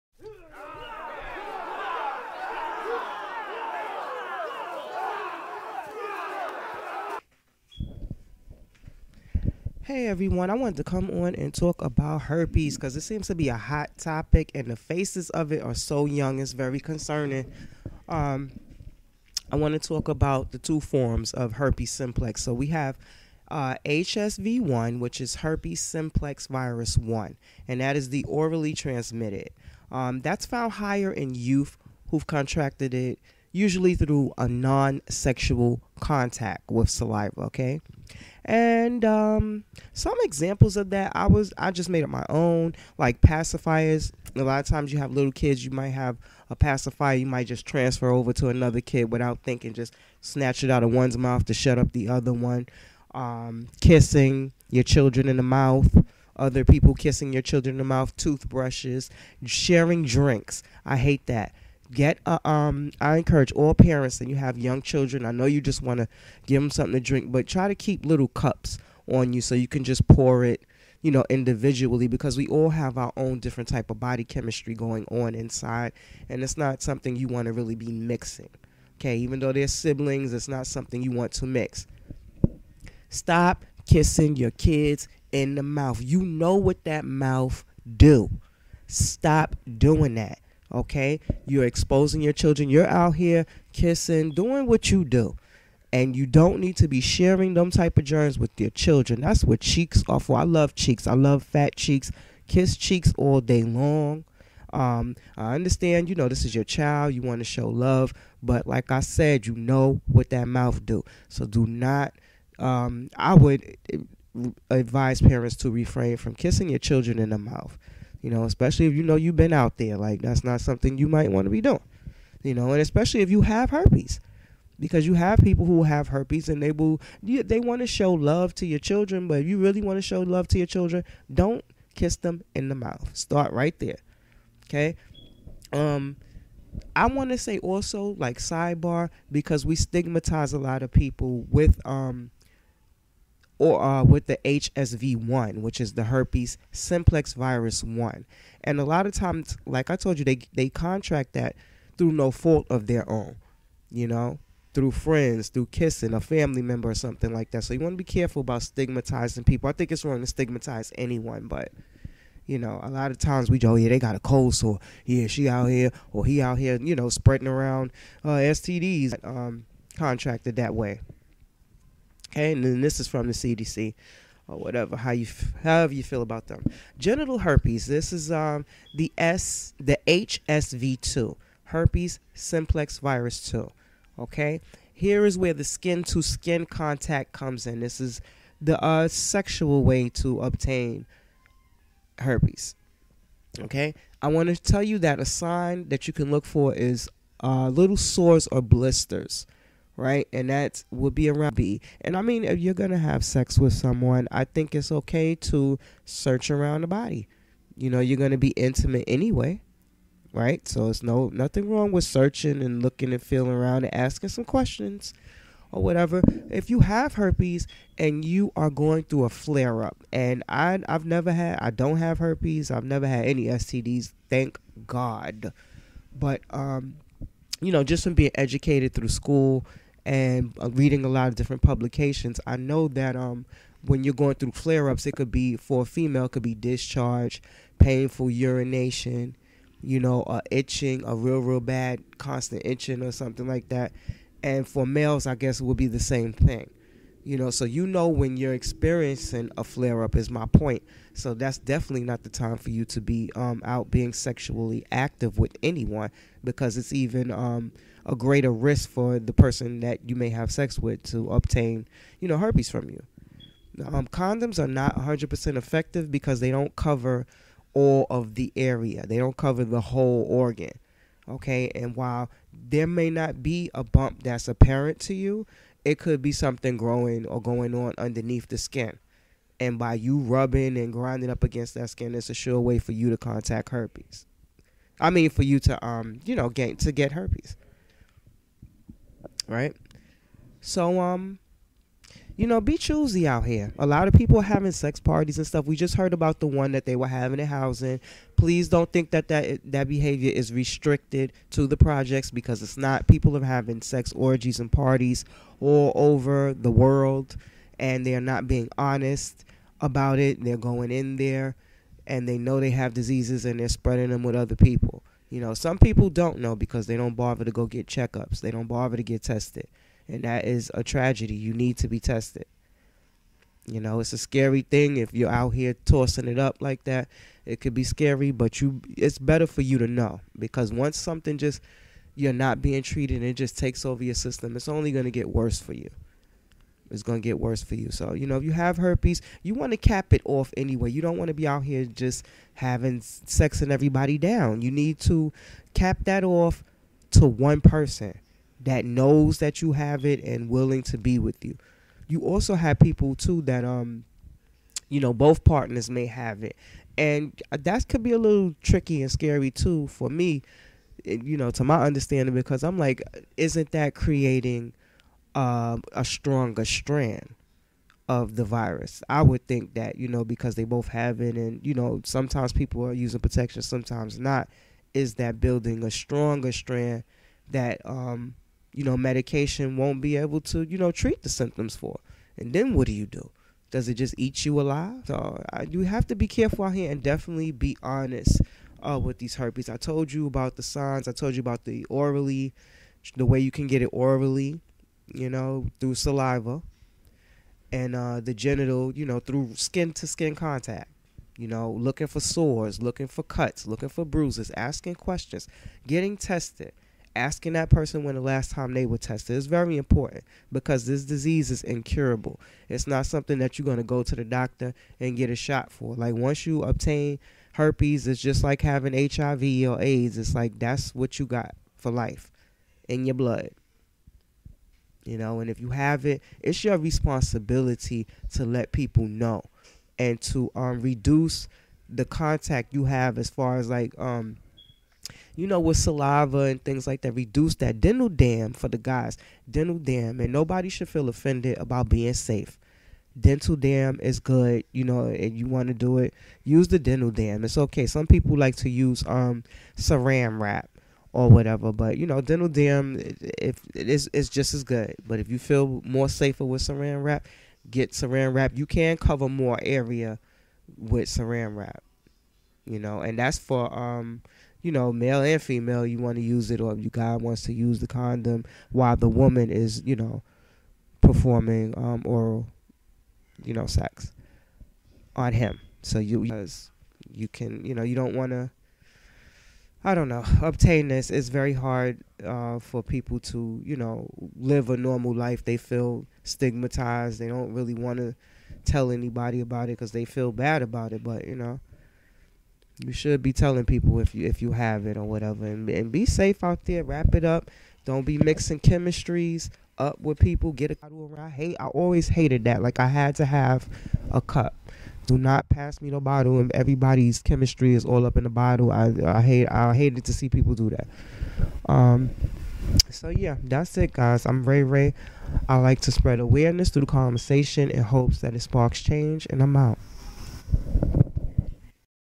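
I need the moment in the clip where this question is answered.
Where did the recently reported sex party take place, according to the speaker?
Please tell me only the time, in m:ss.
4:57.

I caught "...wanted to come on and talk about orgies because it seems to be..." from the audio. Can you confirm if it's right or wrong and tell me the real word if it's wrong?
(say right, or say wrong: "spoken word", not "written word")
wrong: "herpes", not "orgies".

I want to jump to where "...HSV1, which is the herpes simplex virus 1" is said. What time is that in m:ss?
2:24.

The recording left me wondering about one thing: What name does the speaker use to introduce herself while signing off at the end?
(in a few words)
Ray Ray.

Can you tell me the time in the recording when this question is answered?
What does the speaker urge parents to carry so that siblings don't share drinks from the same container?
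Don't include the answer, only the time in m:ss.
1:08.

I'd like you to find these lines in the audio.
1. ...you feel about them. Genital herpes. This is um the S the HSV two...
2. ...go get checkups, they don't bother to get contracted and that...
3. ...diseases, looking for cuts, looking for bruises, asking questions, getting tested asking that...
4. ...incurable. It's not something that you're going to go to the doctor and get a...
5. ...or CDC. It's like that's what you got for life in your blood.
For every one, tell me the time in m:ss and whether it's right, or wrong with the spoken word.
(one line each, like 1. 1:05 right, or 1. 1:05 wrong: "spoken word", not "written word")
1. 2:55 right
2. 5:17 wrong: "tested", not "contracted"
3. 6:42 wrong: "sores", not "diseases"
4. 6:51 right
5. 6:59 wrong: "AIDS", not "CDC".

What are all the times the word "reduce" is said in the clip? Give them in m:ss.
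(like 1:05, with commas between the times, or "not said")
7:10, 7:17.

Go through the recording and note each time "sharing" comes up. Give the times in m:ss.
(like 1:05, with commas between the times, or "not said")
0:59, 1:37.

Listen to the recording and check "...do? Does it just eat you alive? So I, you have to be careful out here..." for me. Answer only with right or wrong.
right.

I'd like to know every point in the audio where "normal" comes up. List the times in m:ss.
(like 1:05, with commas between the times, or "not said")
8:04.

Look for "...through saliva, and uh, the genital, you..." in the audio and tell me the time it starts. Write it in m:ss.
6:35.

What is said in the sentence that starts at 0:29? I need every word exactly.
Um, that's found higher in youth who've contracted it usually through a non sexual contact with saliva, okay?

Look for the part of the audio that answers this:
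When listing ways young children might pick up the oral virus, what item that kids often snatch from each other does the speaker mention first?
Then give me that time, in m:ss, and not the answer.
0:43.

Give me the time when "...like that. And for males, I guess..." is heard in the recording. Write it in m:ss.
4:03.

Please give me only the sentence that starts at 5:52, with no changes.
You also have people too that um you know both partners may have it.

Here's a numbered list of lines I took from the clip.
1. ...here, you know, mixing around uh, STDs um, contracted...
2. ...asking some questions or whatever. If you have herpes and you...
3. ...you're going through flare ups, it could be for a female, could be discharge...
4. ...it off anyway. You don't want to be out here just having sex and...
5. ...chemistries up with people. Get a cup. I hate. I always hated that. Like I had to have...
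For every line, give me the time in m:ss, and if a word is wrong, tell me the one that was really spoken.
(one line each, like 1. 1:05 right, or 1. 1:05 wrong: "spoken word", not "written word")
1. 2:46 wrong: "spreading", not "mixing"
2. 3:33 right
3. 3:54 right
4. 5:40 right
5. 8:18 right.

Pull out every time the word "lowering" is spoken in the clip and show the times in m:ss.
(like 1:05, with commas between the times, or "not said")
not said.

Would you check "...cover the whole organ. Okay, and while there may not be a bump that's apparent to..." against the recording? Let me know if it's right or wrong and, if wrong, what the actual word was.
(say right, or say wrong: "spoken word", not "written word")
right.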